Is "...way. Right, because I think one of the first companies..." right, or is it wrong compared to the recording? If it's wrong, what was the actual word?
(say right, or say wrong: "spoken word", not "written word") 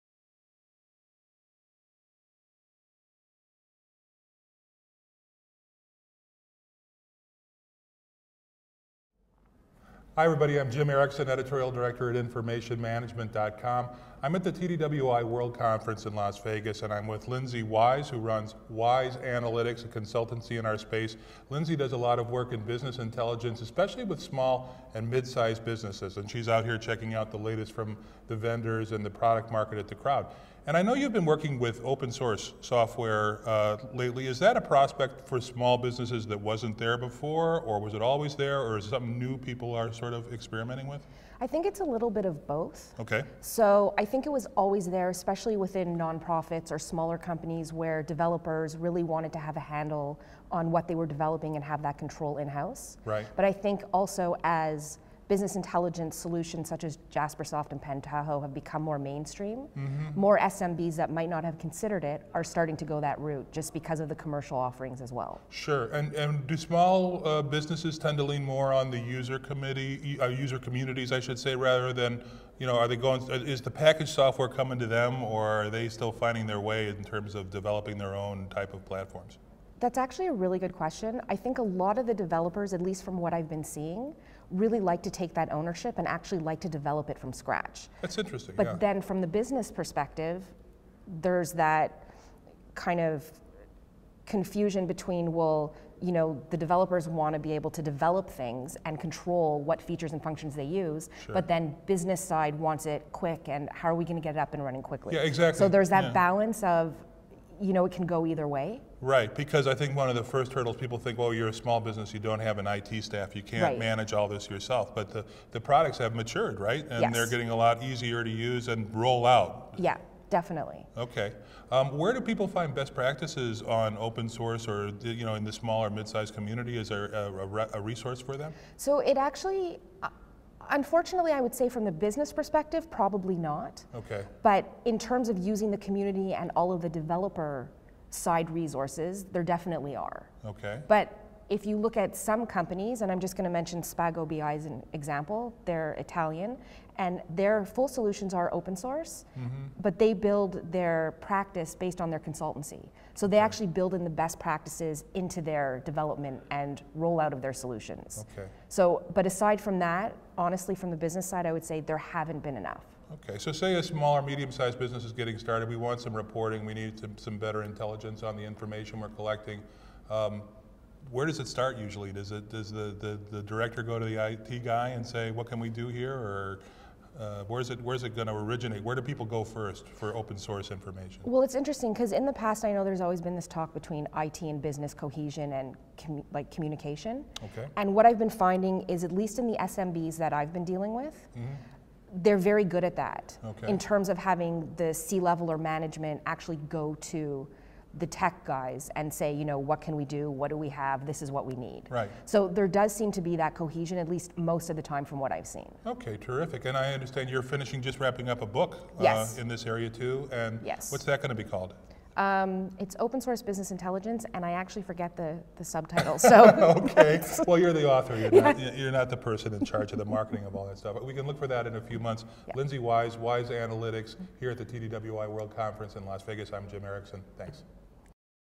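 wrong: "hurdles", not "companies".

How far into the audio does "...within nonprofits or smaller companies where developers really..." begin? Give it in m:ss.
0:45.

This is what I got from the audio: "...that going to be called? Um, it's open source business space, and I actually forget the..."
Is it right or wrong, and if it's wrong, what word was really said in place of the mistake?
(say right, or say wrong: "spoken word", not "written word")
wrong: "intelligence", not "space".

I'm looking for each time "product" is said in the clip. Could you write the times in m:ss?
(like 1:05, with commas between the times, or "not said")
0:29, 1:55.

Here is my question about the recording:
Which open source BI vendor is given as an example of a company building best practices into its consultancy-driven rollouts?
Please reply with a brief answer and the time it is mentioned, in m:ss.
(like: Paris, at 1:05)
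Spago BI, at 2:23.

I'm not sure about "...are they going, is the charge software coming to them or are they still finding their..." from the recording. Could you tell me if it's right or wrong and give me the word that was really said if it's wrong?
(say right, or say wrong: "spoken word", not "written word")
wrong: "package", not "charge".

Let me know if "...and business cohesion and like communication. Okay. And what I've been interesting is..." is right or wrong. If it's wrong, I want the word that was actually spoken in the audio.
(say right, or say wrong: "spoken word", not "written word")
wrong: "finding", not "interesting".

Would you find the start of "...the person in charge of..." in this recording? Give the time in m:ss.
3:39.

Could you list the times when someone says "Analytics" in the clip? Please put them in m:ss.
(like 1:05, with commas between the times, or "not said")
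0:19, 3:43.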